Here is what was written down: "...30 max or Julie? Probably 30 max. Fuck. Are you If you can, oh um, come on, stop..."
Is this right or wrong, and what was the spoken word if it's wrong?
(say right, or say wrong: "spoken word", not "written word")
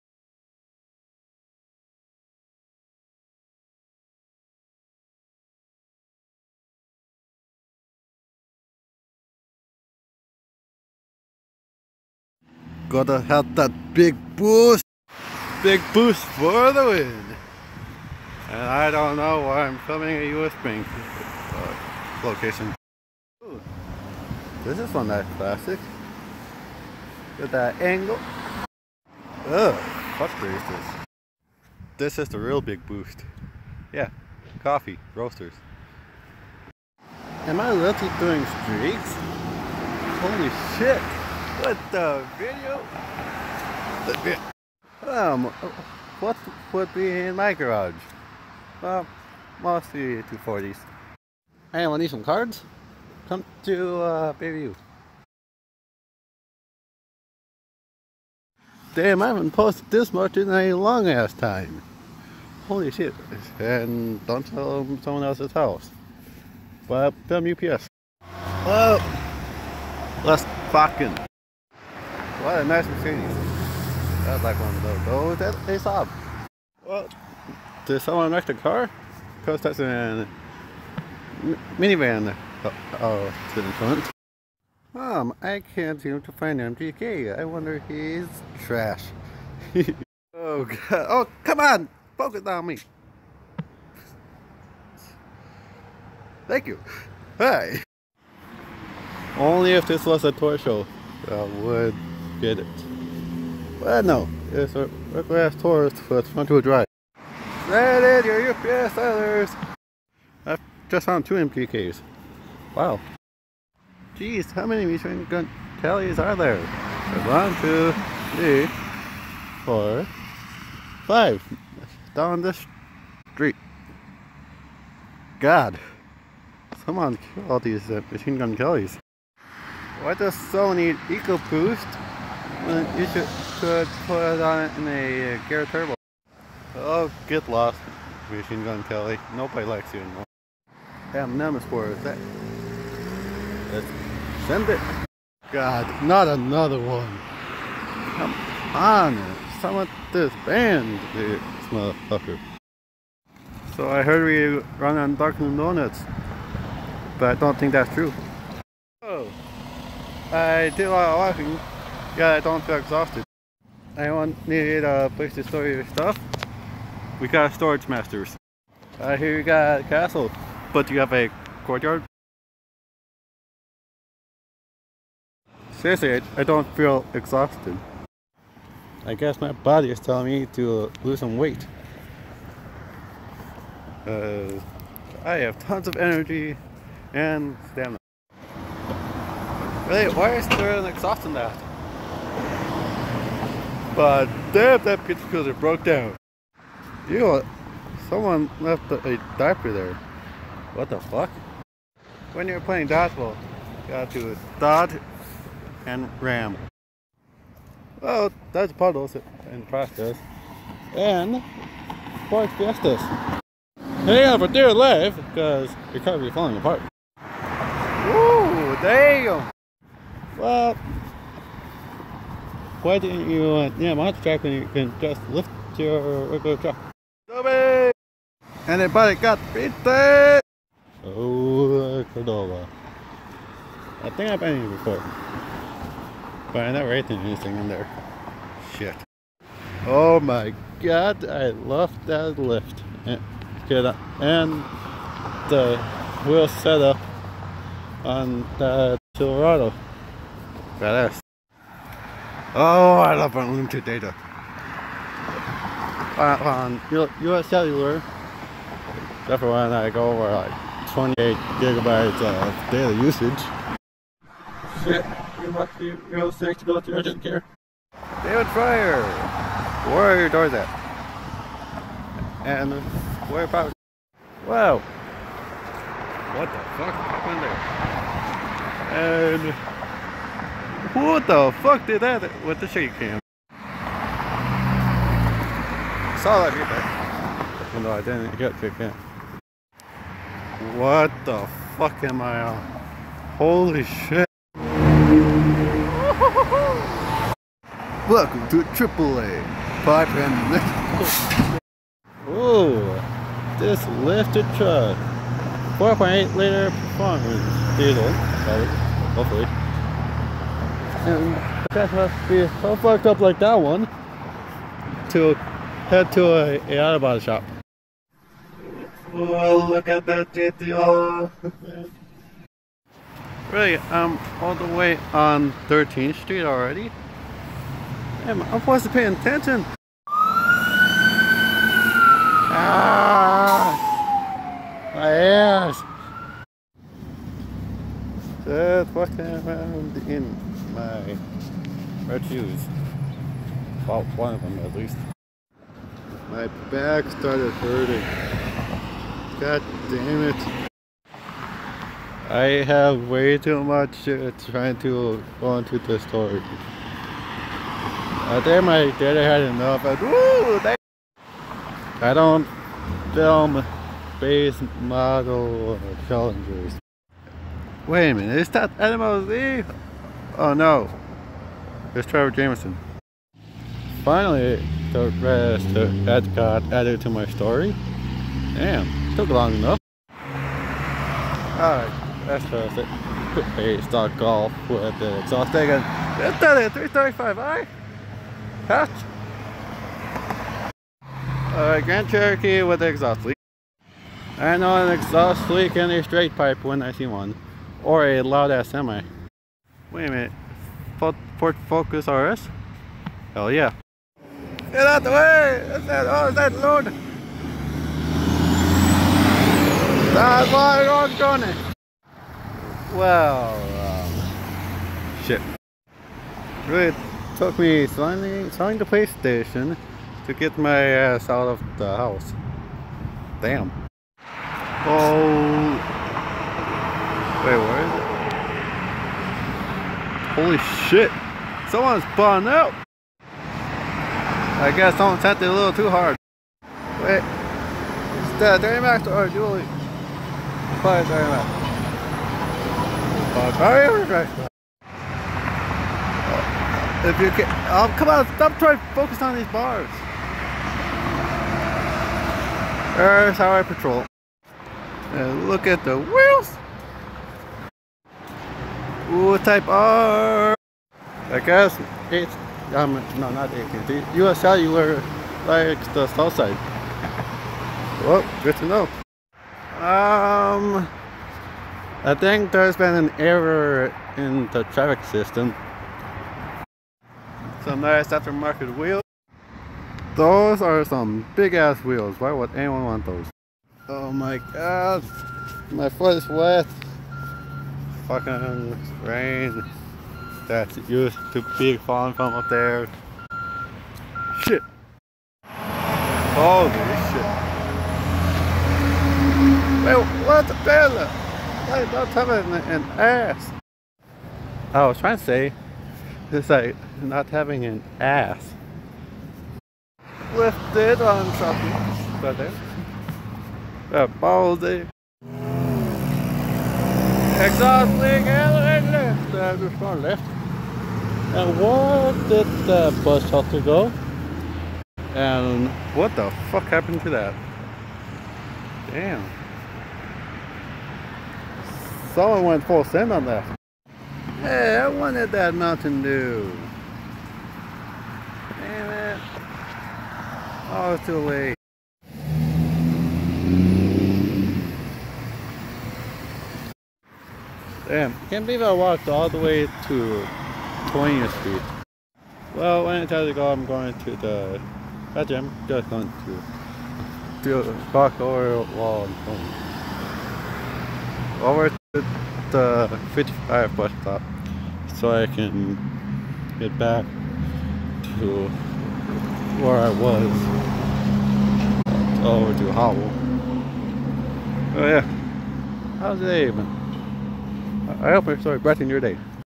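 right.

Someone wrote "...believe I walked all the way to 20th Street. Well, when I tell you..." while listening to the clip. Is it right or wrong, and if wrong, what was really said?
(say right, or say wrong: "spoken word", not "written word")
right.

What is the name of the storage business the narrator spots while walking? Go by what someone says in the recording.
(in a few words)
Storage Masters.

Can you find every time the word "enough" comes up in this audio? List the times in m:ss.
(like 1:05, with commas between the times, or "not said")
5:59, 6:19.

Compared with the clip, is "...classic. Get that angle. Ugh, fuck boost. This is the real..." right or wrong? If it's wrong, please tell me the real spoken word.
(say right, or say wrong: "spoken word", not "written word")
wrong: "racist", not "boost".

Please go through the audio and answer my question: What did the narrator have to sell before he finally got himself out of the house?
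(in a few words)
PlayStation.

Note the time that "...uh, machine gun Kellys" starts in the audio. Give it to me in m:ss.
2:07.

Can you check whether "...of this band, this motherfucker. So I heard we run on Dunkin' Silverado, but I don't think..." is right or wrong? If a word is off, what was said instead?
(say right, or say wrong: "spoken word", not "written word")
wrong: "Donuts", not "Silverado".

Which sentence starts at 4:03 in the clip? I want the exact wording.
And, and the wheel setup on the Silverado.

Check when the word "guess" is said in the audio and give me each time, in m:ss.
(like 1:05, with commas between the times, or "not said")
2:59, 7:14, 7:41.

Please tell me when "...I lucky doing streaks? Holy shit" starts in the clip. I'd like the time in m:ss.
0:37.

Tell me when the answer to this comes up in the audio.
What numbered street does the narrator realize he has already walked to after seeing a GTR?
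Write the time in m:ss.
5:25.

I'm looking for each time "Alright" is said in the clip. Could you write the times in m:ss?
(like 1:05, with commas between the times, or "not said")
6:21, 6:31.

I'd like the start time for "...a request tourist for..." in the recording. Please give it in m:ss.
1:44.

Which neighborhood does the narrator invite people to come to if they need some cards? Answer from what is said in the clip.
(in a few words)
Bayview.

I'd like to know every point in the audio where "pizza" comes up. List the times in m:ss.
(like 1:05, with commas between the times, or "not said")
3:15, 3:49.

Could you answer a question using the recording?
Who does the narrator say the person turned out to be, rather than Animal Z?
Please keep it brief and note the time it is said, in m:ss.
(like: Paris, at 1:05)
Trevor Jameson, at 6:12.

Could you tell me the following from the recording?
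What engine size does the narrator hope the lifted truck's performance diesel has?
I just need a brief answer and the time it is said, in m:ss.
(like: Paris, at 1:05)
4.8 liter, at 5:05.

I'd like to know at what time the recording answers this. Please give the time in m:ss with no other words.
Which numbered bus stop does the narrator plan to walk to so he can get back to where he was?
9:23.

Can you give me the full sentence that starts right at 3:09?
Really, why is there an exhaust in that?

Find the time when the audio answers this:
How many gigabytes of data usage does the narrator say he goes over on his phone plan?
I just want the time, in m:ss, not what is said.
4:20.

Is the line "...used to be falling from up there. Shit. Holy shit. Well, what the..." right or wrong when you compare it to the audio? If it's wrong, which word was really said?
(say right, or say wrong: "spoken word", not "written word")
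right.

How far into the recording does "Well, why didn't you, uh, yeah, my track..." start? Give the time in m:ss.
3:40.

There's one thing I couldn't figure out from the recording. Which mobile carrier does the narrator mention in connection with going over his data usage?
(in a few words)
US Cellular.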